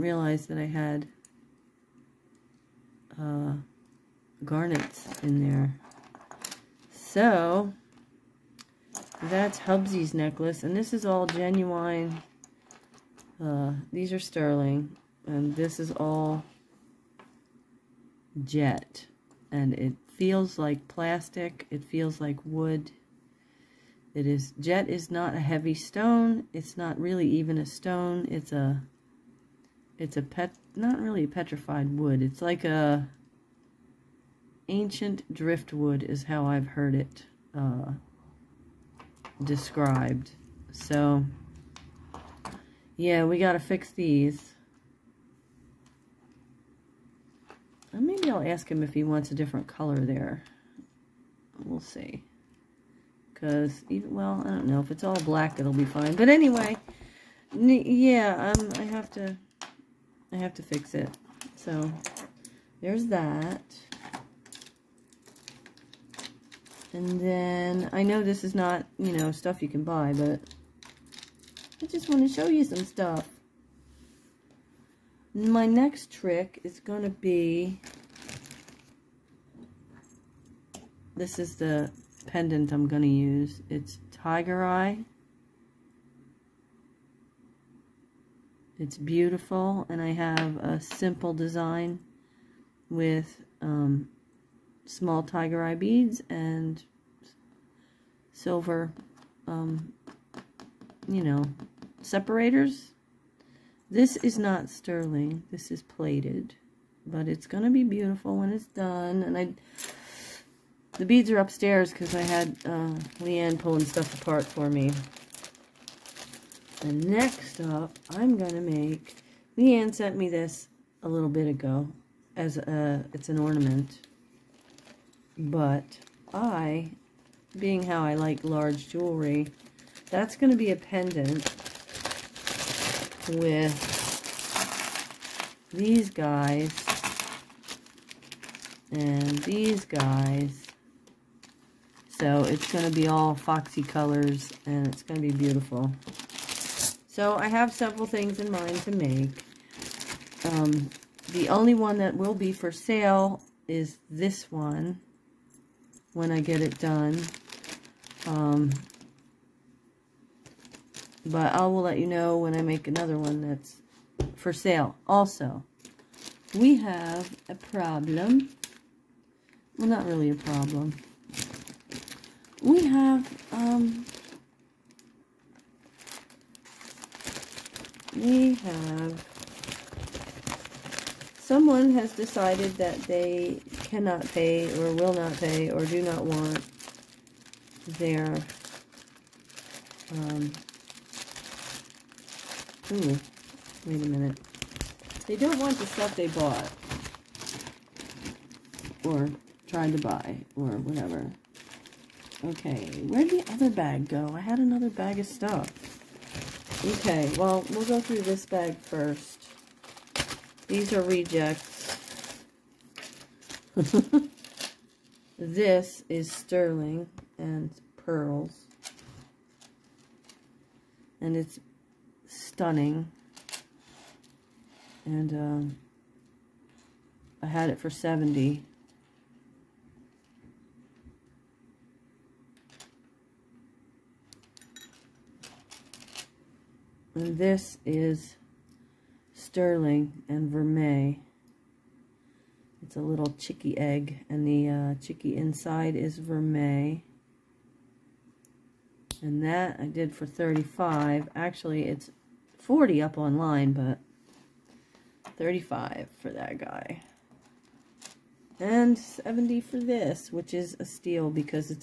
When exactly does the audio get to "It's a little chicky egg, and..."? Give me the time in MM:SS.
04:02.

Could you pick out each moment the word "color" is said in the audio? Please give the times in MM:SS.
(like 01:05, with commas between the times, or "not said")
00:49, 02:23.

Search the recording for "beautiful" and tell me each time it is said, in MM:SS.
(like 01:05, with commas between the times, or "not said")
01:28, 01:47, 02:25.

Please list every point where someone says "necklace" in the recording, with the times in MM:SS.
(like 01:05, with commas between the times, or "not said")
00:10.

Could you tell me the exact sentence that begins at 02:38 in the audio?
Um, but I will let you know when I make another one that's for sale.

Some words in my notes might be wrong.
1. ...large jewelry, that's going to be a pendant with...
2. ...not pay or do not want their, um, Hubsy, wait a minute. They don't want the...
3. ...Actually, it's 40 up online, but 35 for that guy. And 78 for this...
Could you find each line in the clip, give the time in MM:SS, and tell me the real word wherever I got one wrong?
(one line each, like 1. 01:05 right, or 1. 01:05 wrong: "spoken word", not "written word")
1. 02:08 right
2. 03:05 wrong: "Ooh", not "Hubsy"
3. 04:11 wrong: "70", not "78".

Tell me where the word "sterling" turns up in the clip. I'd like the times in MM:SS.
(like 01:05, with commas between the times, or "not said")
00:14, 01:44, 03:36, 03:59.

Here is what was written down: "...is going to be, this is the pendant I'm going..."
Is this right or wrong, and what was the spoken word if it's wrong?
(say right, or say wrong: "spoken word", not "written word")
right.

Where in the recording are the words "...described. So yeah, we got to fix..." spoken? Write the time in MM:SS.
00:39.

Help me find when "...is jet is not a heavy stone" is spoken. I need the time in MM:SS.
00:24.